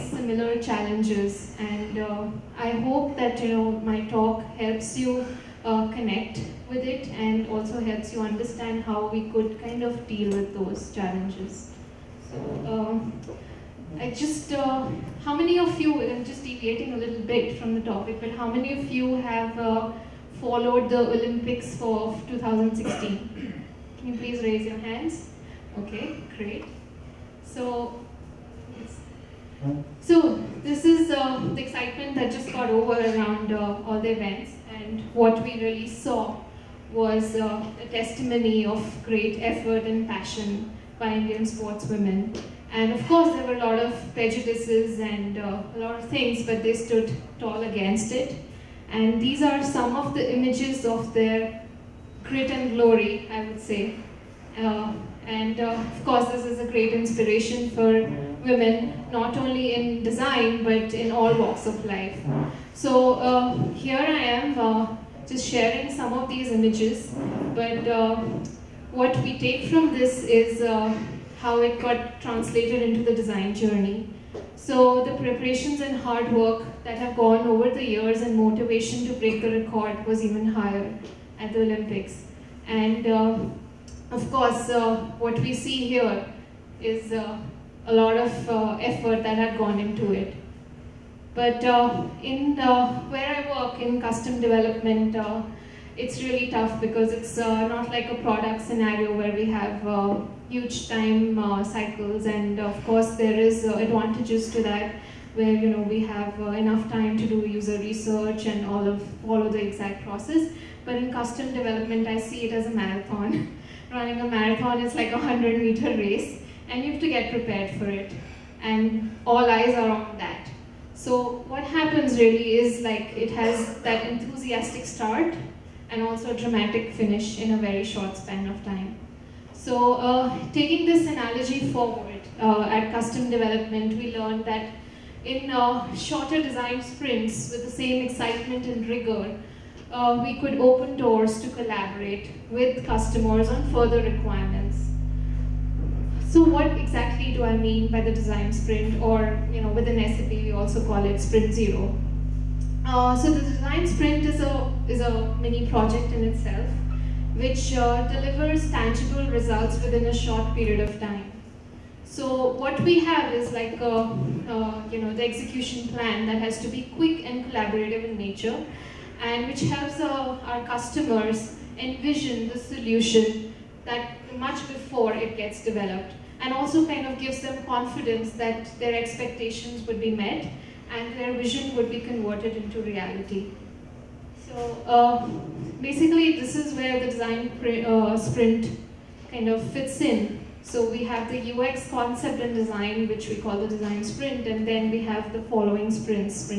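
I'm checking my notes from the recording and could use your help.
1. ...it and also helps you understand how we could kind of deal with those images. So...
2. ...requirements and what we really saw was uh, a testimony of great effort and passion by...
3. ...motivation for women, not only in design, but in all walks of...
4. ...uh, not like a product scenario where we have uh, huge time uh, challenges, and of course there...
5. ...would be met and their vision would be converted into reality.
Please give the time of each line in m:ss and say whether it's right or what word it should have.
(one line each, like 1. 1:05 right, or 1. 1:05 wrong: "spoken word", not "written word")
1. 0:06 wrong: "challenges", not "images"
2. 0:34 wrong: "events", not "requirements"
3. 0:56 wrong: "inspiration", not "motivation"
4. 1:37 wrong: "cycles", not "challenges"
5. 2:59 right.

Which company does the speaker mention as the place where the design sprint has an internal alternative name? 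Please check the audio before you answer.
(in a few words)
SAP.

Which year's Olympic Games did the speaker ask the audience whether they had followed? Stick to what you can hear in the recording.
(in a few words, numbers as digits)
2016.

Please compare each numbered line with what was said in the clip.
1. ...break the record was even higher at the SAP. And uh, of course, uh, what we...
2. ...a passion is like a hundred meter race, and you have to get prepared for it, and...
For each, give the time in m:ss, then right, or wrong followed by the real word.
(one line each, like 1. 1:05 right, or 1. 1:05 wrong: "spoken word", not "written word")
1. 1:19 wrong: "Olympics", not "SAP"
2. 1:54 wrong: "marathon", not "passion".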